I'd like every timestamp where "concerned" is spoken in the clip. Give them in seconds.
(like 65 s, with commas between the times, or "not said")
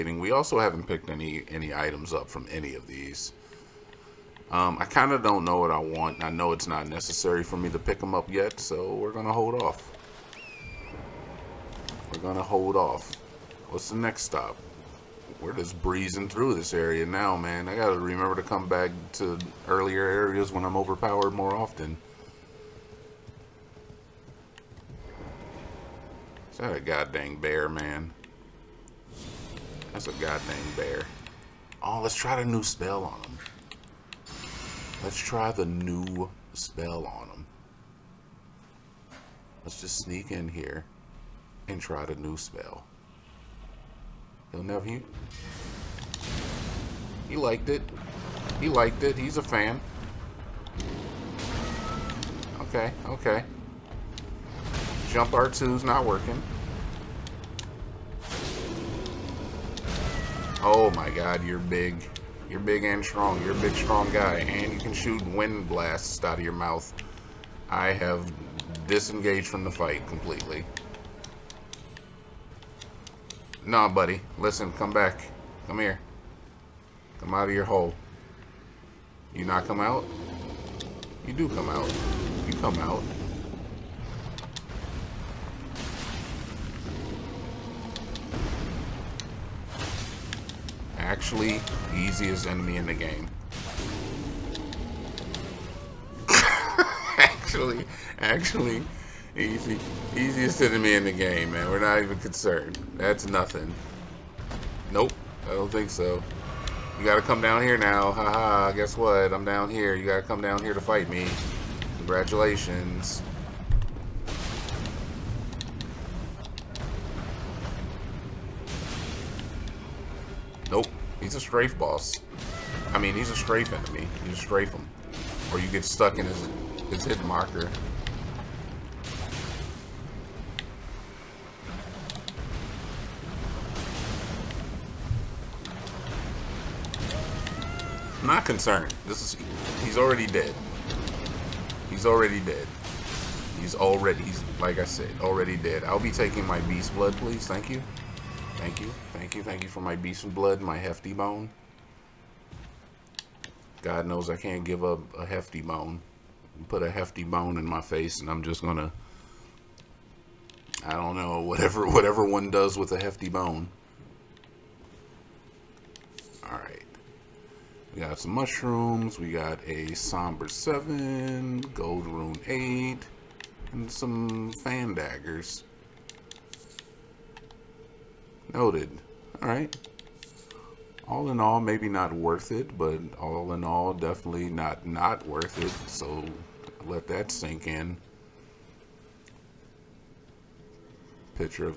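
102 s, 138 s.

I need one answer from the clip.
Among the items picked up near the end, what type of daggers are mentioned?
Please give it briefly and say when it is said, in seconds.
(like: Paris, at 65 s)
Fan daggers, at 174 s.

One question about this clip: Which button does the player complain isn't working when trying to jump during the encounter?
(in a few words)
R2.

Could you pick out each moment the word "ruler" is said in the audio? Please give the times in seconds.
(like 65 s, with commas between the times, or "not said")
not said.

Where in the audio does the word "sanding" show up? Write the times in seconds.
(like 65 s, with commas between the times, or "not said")
not said.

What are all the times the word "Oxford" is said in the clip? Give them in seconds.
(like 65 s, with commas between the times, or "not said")
not said.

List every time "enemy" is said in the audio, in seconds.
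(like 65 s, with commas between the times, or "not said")
92 s, 100 s, 123 s.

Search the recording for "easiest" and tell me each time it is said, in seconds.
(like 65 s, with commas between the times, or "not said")
91 s, 100 s.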